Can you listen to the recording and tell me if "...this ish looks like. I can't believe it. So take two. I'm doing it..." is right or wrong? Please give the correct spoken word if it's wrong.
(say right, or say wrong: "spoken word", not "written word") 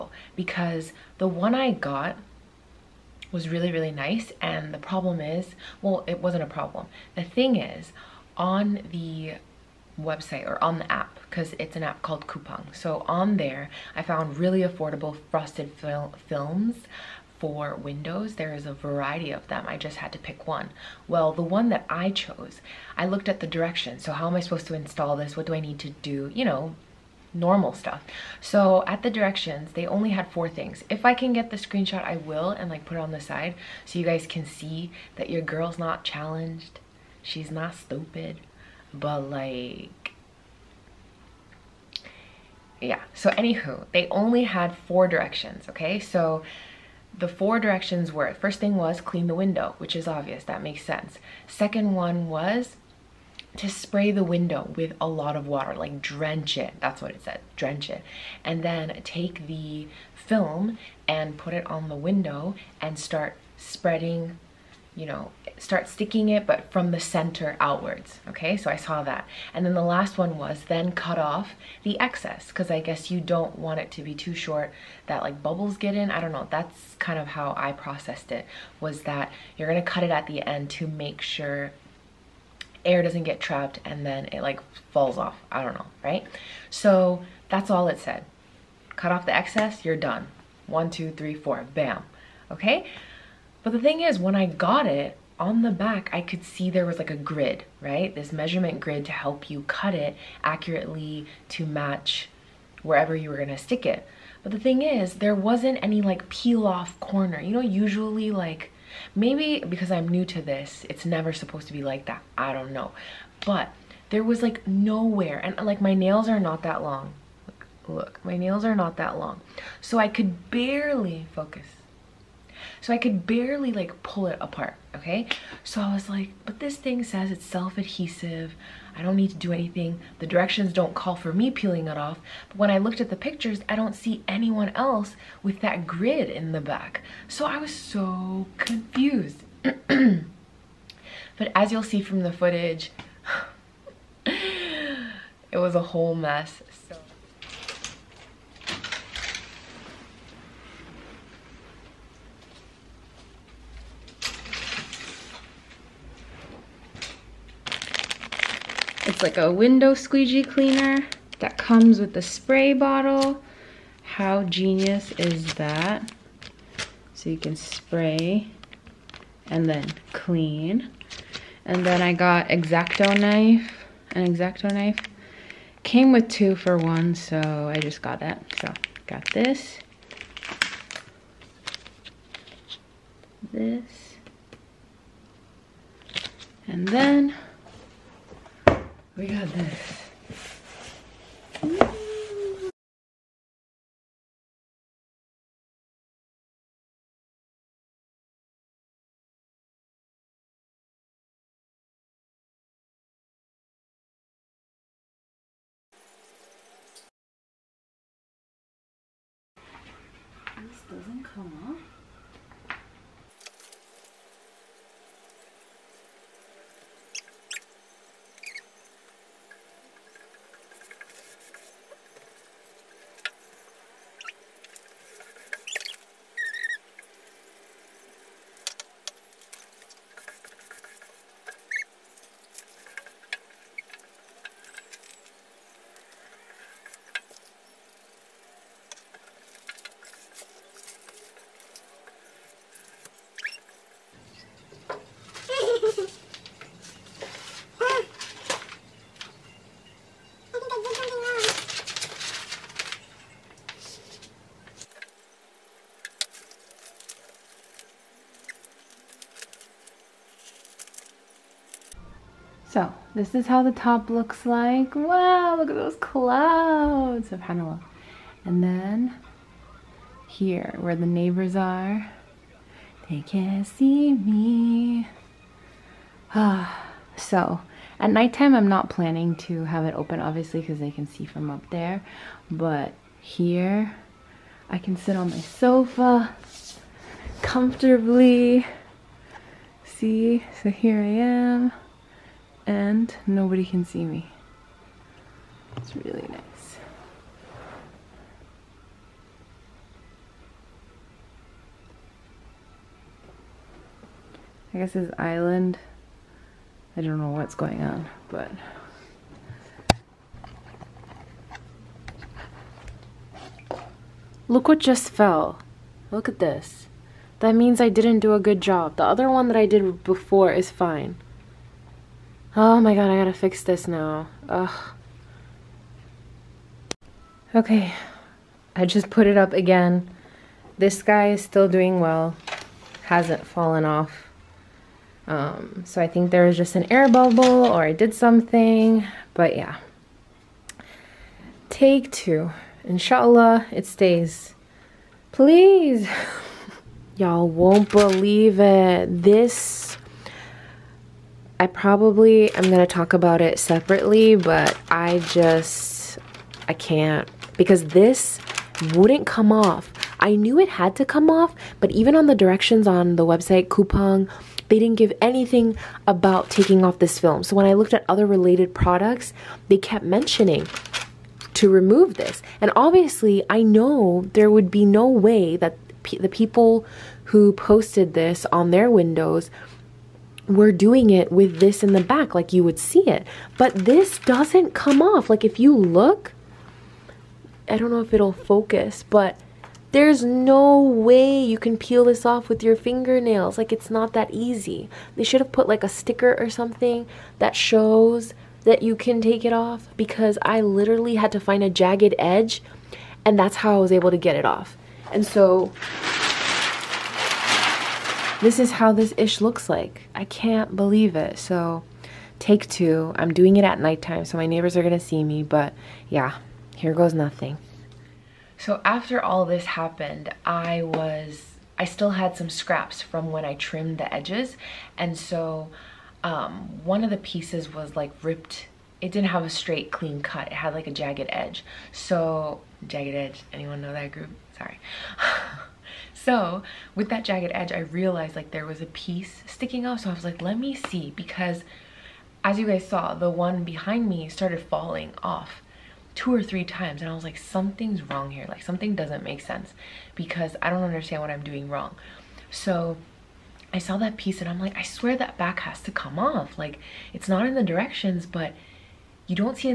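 right.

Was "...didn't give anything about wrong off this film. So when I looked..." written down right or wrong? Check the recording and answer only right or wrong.
wrong.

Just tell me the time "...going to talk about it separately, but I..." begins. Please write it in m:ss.
5:52.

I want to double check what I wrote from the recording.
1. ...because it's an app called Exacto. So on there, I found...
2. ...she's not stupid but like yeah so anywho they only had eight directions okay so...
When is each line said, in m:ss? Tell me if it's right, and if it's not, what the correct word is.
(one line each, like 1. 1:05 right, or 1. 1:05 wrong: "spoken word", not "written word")
1. 0:11 wrong: "Coupang", not "Exacto"
2. 0:37 wrong: "four", not "eight".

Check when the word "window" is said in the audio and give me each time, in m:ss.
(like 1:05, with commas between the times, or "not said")
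0:17, 0:49, 0:54, 1:01, 2:39, 6:18.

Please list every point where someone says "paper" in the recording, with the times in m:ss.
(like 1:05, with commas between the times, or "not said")
not said.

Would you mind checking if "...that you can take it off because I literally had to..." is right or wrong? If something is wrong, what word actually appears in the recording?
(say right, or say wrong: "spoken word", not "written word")
right.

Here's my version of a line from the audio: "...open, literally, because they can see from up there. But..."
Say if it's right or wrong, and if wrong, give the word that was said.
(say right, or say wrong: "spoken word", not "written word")
wrong: "obviously", not "literally".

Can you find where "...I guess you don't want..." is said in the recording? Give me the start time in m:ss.
1:12.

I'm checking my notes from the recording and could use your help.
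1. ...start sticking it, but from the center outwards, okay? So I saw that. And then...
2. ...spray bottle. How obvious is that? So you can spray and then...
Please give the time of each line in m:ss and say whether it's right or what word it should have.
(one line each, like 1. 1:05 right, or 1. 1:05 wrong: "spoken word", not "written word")
1. 1:05 right
2. 2:42 wrong: "genius", not "obvious".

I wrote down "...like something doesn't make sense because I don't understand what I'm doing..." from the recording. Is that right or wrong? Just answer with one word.
right.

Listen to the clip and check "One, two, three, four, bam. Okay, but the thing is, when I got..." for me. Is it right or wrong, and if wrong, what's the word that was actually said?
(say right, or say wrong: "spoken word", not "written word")
right.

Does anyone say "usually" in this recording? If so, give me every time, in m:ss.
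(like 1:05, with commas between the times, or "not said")
1:47.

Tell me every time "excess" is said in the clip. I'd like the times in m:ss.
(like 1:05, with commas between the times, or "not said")
1:11, 1:29.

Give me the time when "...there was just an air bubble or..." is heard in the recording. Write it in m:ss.
5:36.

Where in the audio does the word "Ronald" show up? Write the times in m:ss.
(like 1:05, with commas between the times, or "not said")
not said.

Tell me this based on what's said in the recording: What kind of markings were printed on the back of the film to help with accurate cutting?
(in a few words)
Measurement grid.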